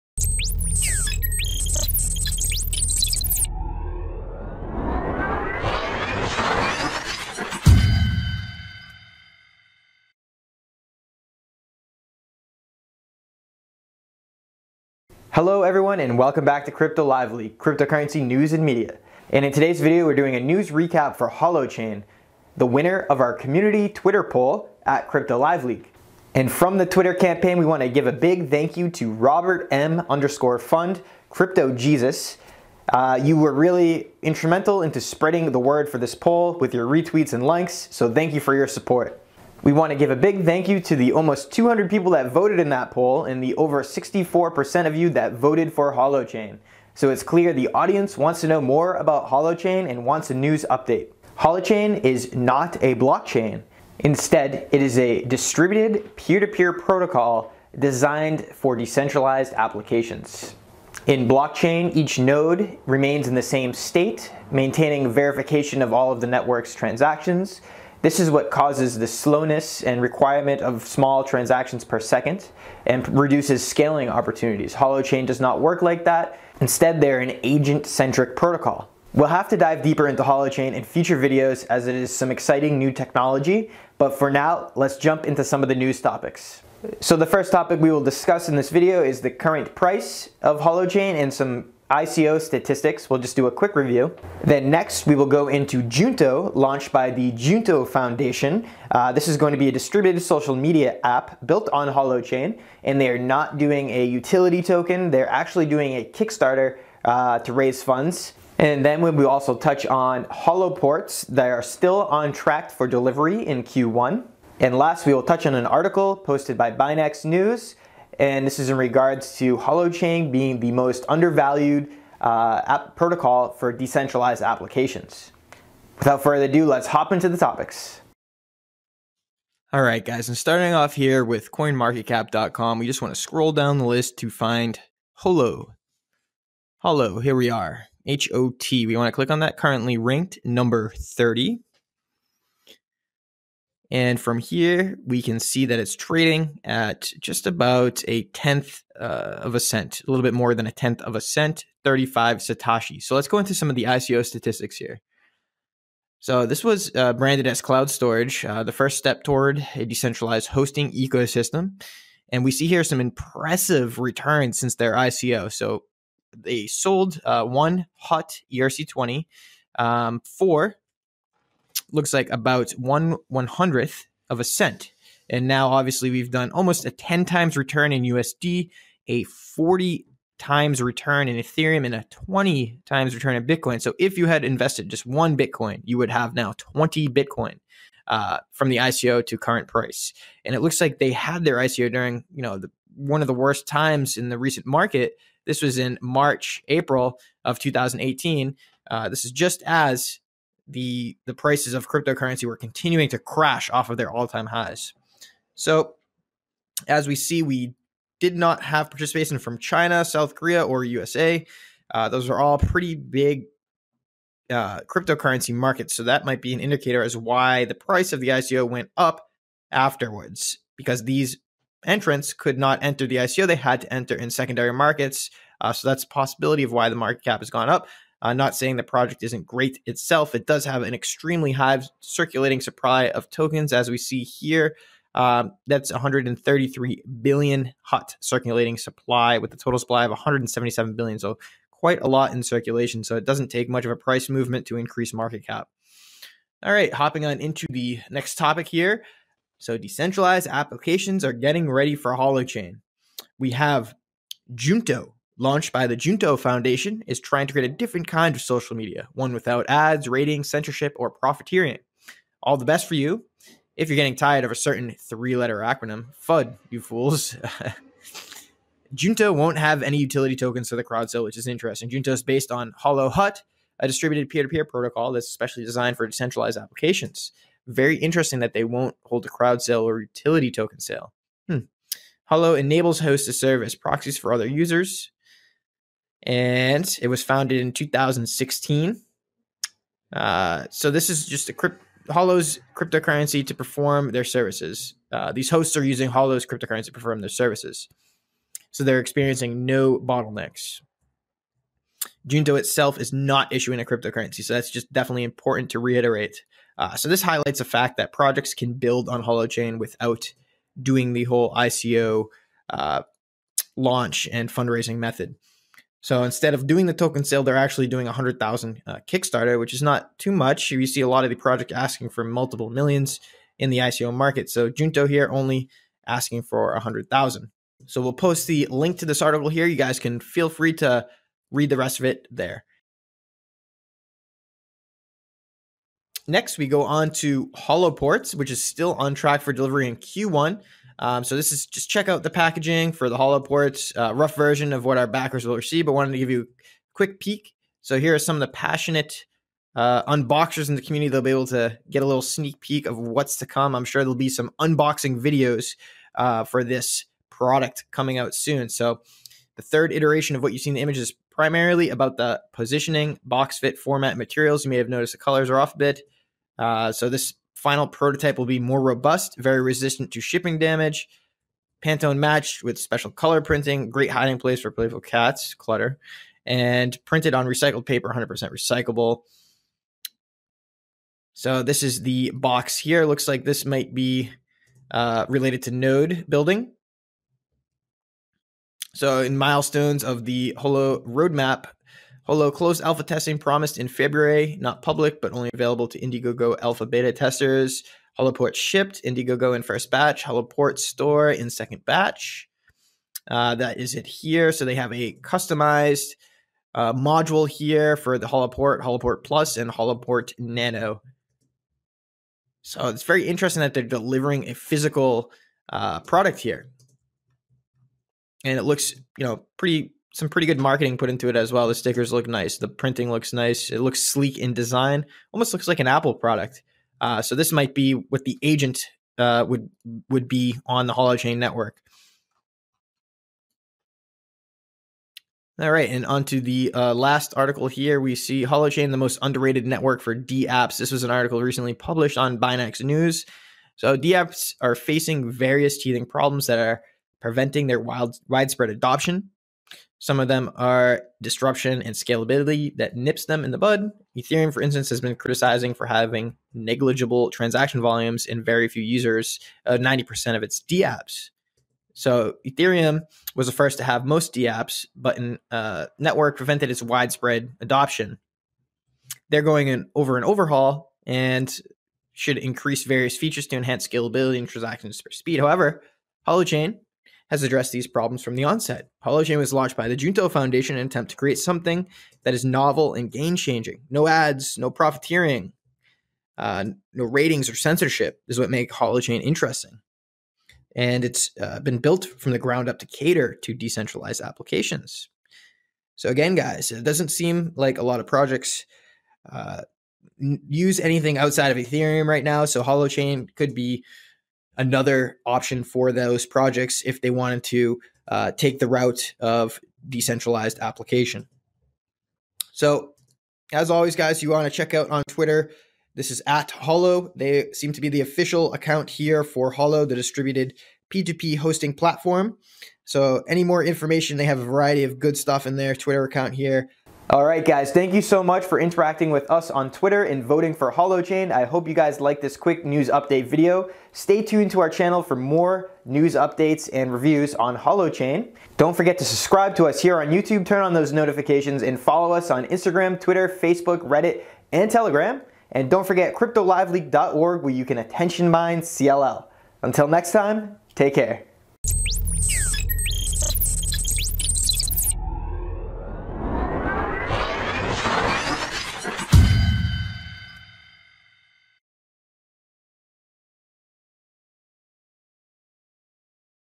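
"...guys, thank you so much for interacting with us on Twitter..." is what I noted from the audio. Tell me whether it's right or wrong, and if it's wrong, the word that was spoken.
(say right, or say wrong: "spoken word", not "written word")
right.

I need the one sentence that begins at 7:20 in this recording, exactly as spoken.
This was an article recently published on Binance News.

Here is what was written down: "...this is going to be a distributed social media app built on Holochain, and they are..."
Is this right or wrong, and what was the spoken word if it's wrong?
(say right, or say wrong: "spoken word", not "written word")
right.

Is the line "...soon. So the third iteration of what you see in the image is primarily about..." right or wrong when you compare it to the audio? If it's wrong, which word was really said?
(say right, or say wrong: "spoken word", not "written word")
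right.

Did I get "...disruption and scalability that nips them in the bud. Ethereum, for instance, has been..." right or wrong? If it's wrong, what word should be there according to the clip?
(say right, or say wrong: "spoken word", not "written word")
right.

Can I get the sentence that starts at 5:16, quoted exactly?
So instead of doing the token sale, they're actually doing 100,000 uh, Kickstarter, which is not too much.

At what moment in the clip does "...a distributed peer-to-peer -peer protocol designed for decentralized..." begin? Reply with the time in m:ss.
0:54.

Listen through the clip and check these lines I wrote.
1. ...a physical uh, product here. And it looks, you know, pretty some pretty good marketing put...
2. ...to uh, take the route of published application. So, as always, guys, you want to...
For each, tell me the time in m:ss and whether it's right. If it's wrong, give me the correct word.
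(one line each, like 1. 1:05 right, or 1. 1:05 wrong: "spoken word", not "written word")
1. 6:54 right
2. 8:27 wrong: "decentralized", not "published".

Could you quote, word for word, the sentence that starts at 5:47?
So here are some of the passionate uh, unboxers in the community.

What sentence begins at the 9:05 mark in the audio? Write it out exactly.
And don't forget CryptoLiveLeak.org where you can attention mine CLL.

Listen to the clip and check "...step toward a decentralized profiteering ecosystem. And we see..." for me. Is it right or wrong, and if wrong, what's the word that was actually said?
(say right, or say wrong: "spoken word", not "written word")
wrong: "hosting", not "profiteering".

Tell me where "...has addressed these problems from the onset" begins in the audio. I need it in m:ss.
7:57.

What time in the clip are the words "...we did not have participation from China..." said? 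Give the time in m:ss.
3:27.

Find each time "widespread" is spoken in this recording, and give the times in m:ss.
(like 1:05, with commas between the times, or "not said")
7:28, 7:46.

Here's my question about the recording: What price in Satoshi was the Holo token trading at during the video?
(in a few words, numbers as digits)
35 Satoshi.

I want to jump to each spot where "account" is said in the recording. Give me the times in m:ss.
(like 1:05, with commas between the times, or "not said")
8:38, 8:46.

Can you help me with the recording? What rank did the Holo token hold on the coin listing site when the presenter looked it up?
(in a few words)
30.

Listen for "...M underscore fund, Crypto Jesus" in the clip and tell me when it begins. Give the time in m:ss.
0:29.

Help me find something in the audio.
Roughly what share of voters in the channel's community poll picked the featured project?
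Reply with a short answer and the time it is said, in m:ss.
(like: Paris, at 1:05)
over 64%, at 0:43.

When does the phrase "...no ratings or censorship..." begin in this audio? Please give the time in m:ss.
8:06.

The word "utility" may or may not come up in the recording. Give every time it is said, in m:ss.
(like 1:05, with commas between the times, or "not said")
1:44, 4:29, 4:40.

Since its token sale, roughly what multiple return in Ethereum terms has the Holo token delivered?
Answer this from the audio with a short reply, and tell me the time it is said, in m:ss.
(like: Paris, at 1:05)
40 times, at 2:59.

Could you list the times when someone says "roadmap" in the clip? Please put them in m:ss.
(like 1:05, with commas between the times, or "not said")
6:31.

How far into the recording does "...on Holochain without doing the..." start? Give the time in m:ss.
5:09.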